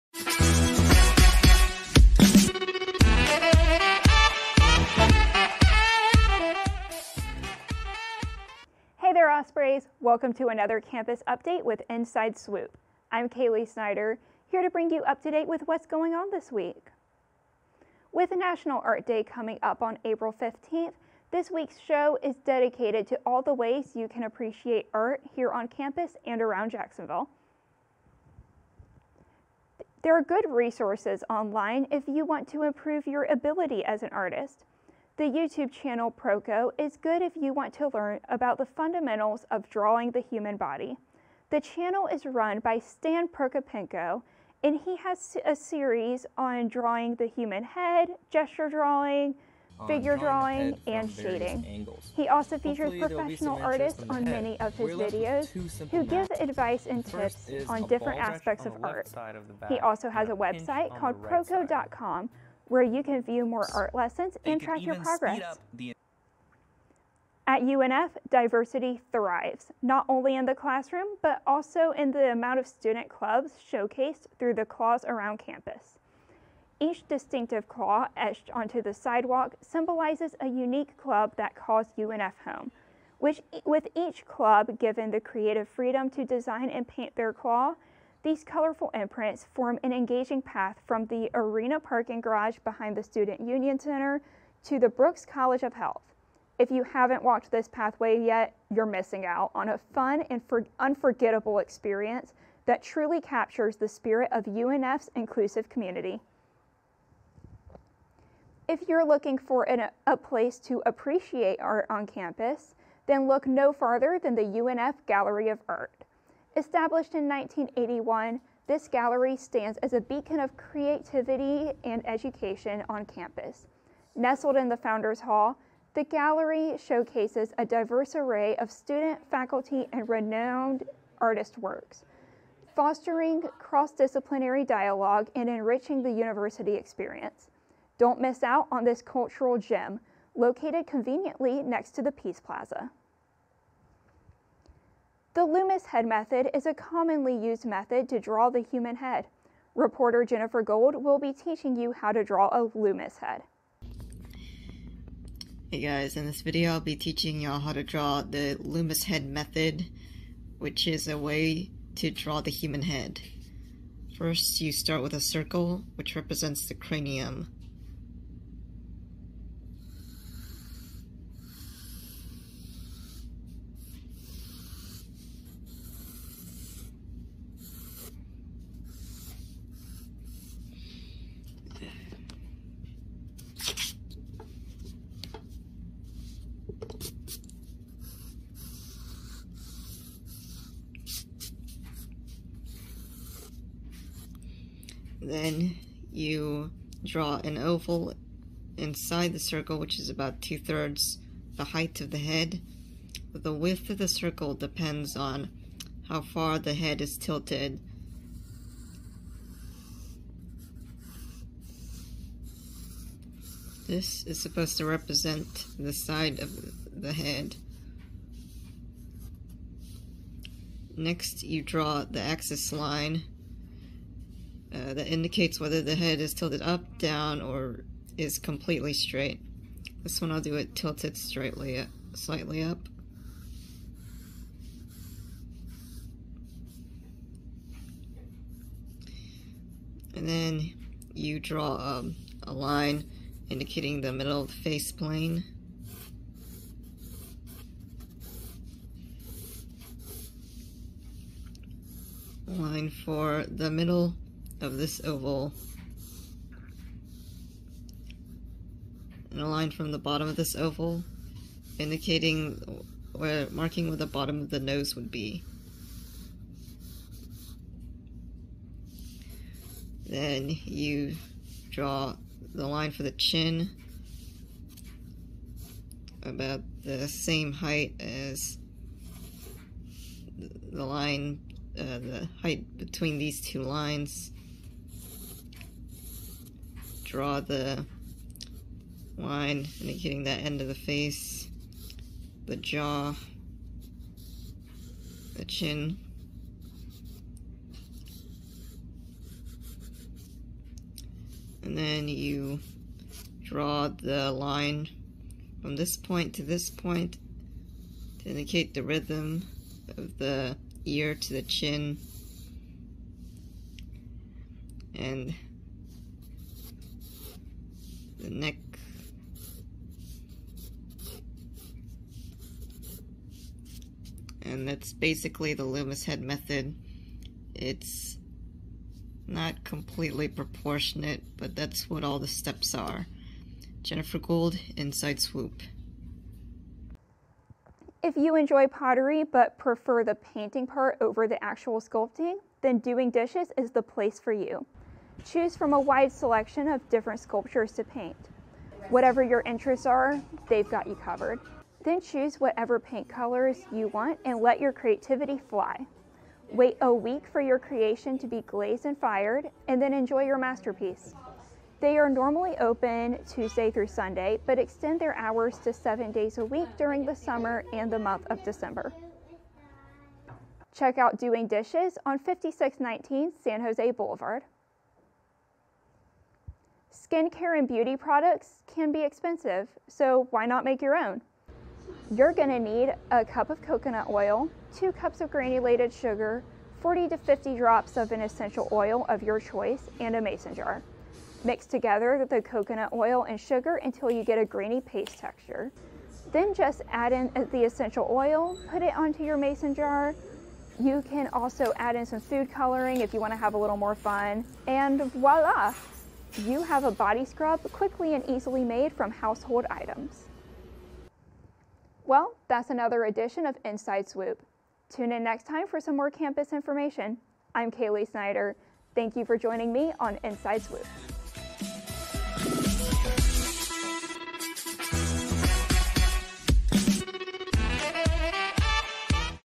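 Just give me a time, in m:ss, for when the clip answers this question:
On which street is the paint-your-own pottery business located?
6:13.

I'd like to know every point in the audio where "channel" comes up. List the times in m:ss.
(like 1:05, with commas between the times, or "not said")
0:35, 0:41.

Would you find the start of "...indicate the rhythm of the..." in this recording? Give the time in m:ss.
5:08.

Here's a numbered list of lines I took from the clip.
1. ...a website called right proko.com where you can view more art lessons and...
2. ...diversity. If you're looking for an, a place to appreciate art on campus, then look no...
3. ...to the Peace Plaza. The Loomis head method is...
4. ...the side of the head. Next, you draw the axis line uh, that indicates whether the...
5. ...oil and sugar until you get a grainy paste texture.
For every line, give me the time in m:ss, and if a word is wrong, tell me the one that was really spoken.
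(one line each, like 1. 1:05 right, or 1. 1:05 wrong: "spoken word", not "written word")
1. 1:00 right
2. 1:45 wrong: "community", not "diversity"
3. 2:21 right
4. 3:35 right
5. 6:32 right.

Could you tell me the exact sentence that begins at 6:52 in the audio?
Well, that's another edition of Inside Swoop.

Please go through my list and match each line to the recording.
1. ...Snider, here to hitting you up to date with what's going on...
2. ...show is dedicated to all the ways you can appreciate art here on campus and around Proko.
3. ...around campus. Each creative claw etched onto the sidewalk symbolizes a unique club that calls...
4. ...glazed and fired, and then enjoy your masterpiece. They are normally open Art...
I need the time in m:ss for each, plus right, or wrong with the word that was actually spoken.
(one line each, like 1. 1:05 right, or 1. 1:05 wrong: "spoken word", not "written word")
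1. 0:13 wrong: "bring", not "hitting"
2. 0:21 wrong: "Jacksonville", not "Proko"
3. 1:15 wrong: "distinctive", not "creative"
4. 5:58 wrong: "Tuesday", not "Art".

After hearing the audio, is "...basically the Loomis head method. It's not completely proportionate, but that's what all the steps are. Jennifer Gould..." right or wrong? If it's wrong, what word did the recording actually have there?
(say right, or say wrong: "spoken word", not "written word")
right.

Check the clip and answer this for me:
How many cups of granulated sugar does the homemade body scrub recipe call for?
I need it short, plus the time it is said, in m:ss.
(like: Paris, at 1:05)
2, at 6:24.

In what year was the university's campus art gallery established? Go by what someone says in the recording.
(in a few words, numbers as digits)
1981.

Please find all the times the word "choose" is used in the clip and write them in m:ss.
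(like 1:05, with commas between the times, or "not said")
5:45, 5:52.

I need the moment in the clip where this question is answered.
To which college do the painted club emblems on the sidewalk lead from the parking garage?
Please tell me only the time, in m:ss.
1:34.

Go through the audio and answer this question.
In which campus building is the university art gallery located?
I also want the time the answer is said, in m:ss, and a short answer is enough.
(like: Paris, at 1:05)
Founders Hall, at 2:04.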